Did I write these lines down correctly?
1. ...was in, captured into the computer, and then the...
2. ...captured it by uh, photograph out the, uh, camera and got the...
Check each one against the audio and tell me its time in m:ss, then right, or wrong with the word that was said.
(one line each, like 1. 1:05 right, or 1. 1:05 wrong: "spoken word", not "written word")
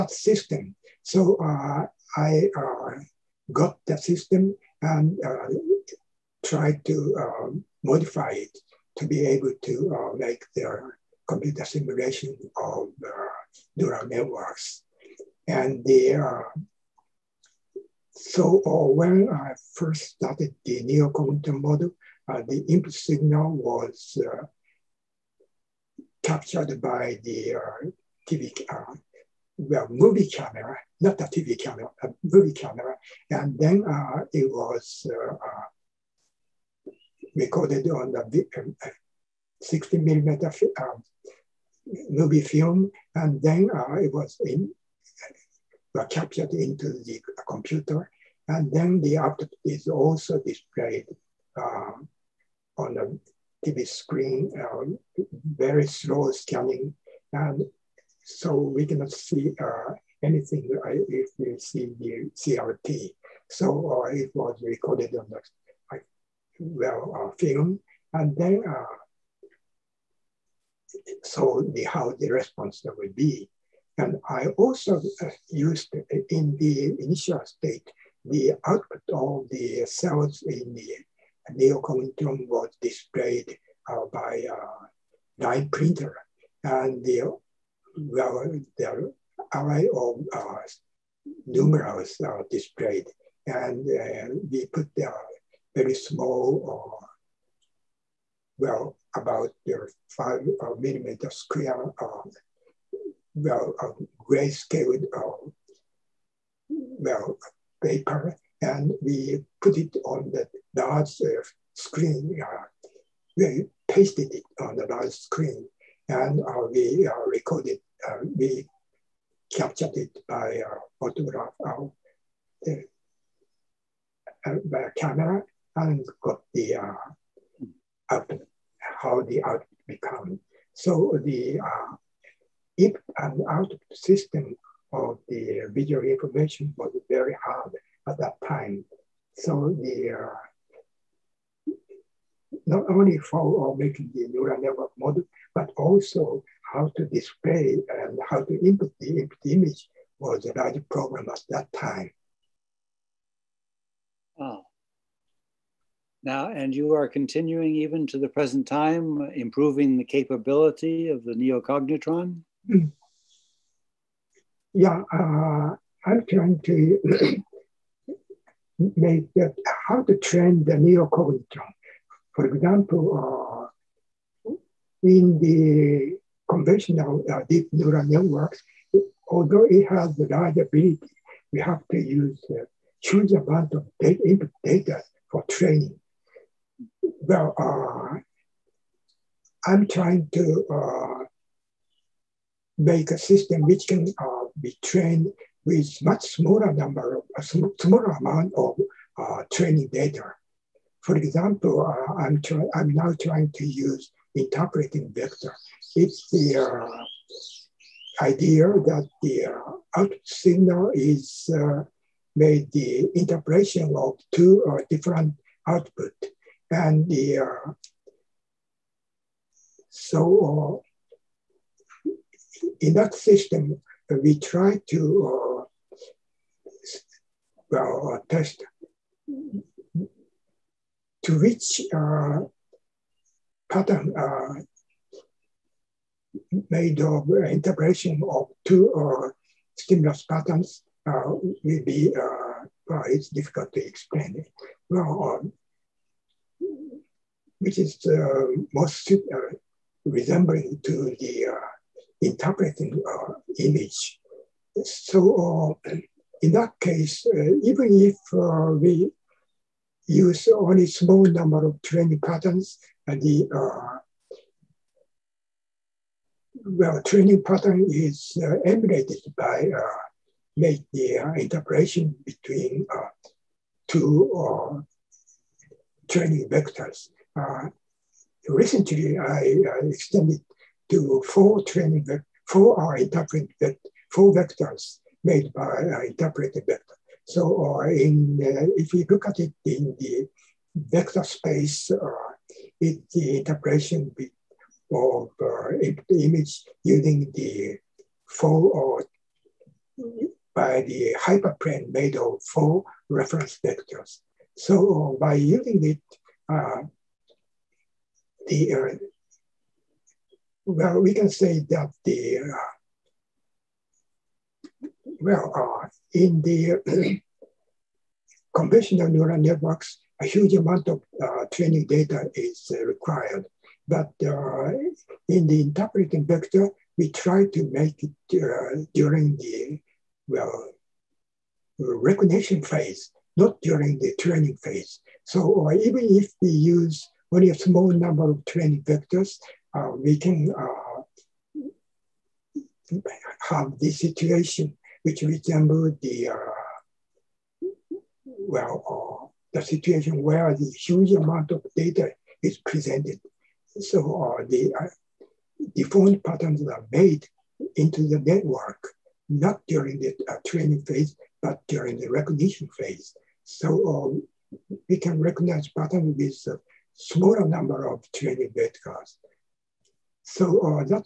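1. 0:44 right
2. 1:59 right.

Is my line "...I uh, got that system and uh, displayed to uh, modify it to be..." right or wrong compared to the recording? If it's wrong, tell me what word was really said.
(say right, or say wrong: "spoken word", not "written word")
wrong: "tried", not "displayed".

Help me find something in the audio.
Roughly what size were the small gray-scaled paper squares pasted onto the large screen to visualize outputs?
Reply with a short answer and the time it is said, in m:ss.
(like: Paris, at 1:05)
About 5 millimeters square, at 1:40.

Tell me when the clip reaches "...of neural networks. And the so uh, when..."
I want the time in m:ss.
0:12.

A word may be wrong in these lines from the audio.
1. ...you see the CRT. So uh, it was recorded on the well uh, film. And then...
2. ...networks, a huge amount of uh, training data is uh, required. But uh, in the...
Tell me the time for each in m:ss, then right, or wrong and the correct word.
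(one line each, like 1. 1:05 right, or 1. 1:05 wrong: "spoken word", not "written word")
1. 1:01 right
2. 5:19 right.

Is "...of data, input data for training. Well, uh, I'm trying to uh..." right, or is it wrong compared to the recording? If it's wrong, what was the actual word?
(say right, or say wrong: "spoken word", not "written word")
right.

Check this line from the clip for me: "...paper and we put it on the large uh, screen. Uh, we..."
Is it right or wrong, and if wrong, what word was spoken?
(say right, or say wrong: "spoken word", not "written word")
right.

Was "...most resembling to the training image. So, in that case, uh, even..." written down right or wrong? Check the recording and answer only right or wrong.
wrong.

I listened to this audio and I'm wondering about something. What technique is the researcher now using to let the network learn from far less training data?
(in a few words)
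Interpolating vector.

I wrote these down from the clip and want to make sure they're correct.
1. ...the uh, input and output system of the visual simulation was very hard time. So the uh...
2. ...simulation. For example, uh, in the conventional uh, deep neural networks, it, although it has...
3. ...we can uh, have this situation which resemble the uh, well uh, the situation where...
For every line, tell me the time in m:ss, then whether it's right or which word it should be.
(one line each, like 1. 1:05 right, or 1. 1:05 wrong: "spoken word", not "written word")
1. 2:11 wrong: "information", not "simulation"
2. 2:50 wrong: "neocognitron", not "simulation"
3. 5:39 right.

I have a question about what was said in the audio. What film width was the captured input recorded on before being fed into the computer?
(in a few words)
60 millimeter.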